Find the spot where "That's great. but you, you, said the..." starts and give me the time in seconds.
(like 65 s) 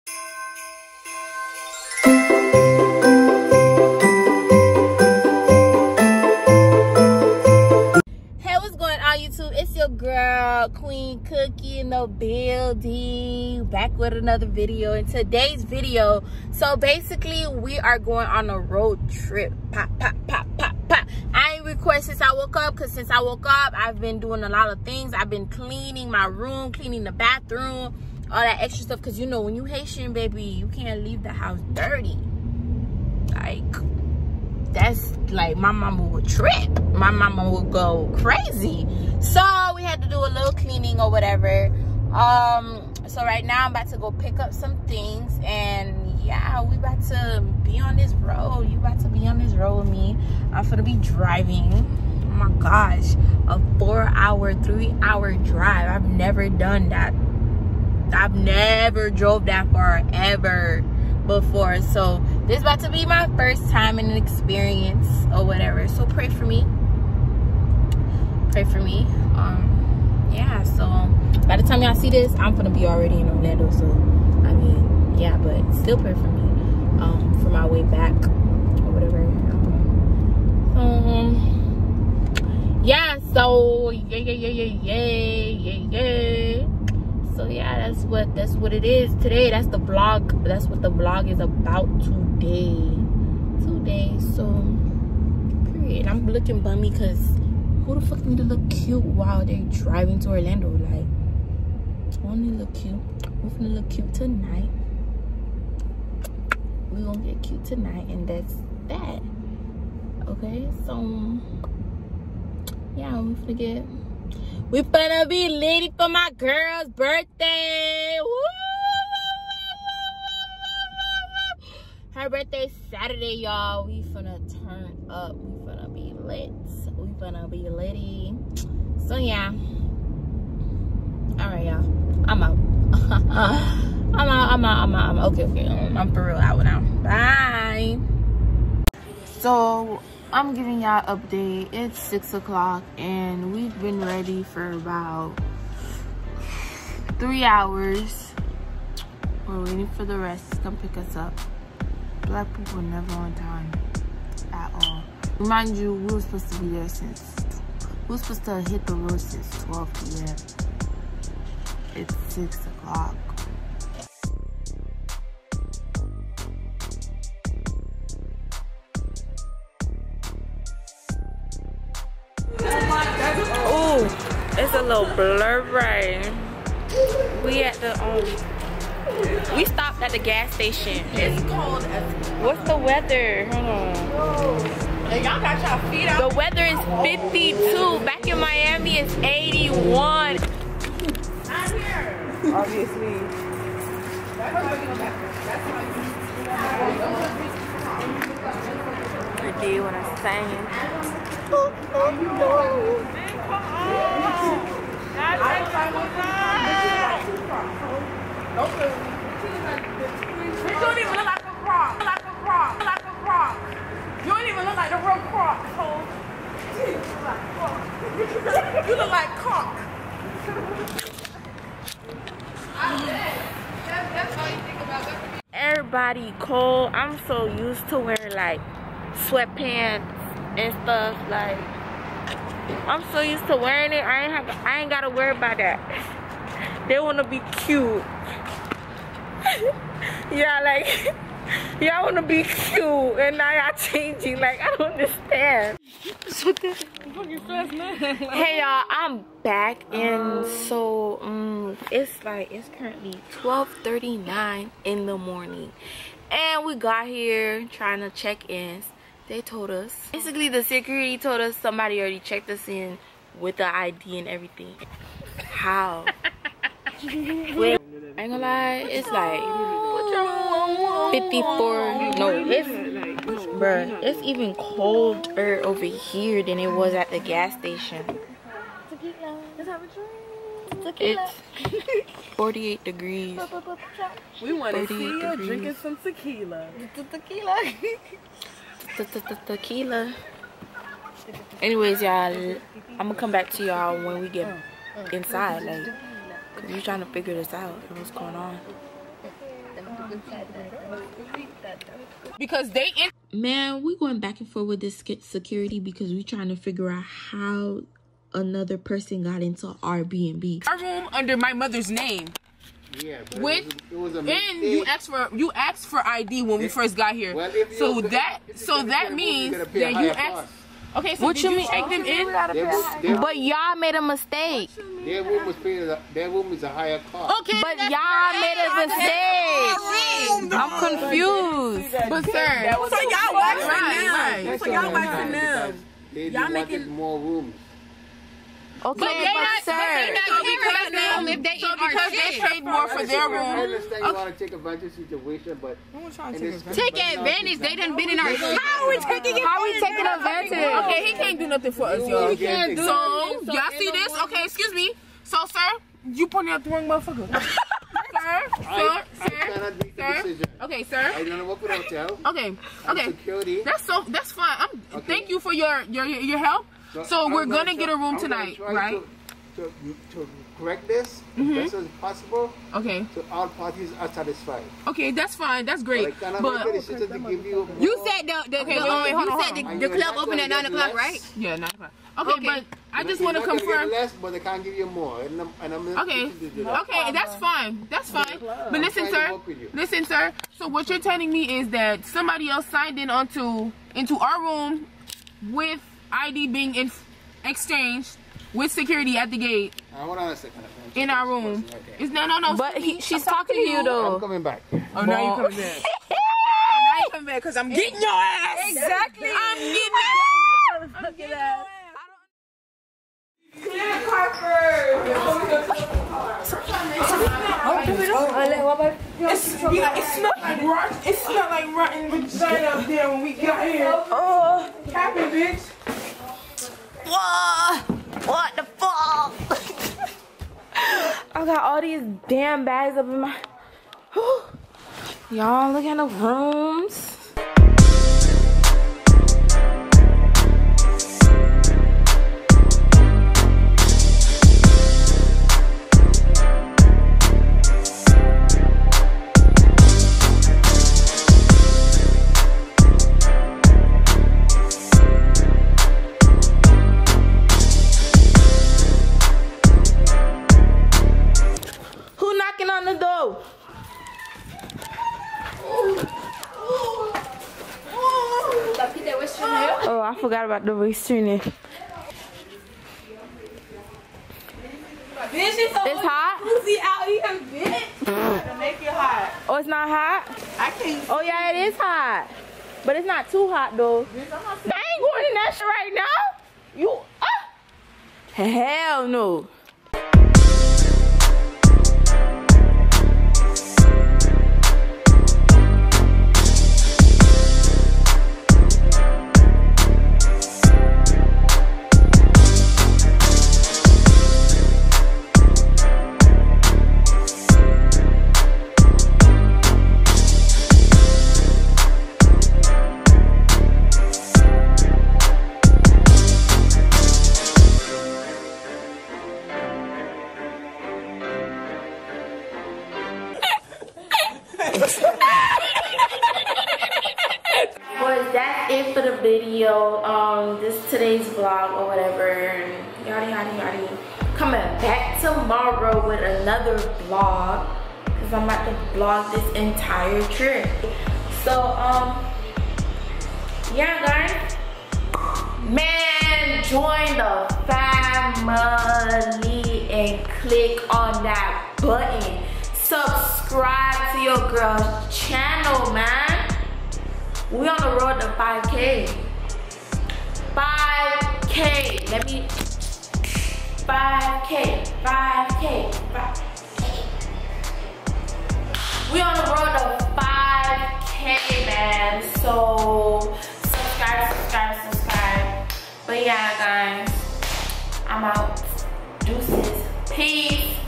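375 s.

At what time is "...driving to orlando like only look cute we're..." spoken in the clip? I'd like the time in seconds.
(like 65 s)
99 s.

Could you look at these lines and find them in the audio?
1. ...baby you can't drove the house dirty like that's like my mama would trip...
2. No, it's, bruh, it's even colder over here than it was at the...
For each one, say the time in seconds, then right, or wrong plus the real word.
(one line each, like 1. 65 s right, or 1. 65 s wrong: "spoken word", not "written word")
1. 30 s wrong: "leave", not "drove"
2. 272 s right.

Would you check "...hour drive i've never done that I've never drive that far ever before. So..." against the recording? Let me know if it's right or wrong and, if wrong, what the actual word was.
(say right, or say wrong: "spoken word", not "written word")
wrong: "drove", not "drive".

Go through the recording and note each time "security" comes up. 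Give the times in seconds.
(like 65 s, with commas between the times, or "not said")
260 s, 305 s, 363 s, 398 s.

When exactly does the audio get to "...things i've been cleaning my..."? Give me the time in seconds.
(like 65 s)
24 s.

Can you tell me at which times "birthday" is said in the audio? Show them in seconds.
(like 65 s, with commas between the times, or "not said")
116 s, 122 s.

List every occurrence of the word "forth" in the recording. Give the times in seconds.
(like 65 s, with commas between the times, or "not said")
304 s.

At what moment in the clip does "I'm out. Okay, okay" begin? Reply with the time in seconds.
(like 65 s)
134 s.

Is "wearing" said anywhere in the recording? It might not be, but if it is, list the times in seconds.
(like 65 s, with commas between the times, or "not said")
227 s, 233 s.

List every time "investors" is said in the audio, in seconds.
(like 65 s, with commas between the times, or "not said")
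not said.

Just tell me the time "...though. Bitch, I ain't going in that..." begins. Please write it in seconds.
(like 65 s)
483 s.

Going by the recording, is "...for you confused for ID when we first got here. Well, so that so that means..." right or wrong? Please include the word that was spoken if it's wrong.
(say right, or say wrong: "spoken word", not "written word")
wrong: "asked", not "confused".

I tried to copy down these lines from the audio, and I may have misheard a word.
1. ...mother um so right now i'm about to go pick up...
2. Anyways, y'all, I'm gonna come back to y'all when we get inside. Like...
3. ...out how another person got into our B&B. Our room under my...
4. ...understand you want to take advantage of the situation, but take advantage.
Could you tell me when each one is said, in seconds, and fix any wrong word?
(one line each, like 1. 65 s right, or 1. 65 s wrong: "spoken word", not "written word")
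1. 41 s wrong: "whatever", not "mother"
2. 291 s right
3. 306 s right
4. 343 s right.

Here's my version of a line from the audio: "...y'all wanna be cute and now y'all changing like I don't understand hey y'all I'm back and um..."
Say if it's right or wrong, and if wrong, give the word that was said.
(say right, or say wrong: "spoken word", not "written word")
right.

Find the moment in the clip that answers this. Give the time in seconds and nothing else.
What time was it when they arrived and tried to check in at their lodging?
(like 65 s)
253 s.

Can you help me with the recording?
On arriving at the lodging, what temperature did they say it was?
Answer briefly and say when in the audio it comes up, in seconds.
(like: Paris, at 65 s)
48 degrees, at 282 s.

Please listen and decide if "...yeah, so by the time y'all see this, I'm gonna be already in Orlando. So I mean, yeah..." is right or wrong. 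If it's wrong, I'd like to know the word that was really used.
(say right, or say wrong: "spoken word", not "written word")
right.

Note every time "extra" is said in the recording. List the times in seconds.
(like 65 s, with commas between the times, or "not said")
28 s.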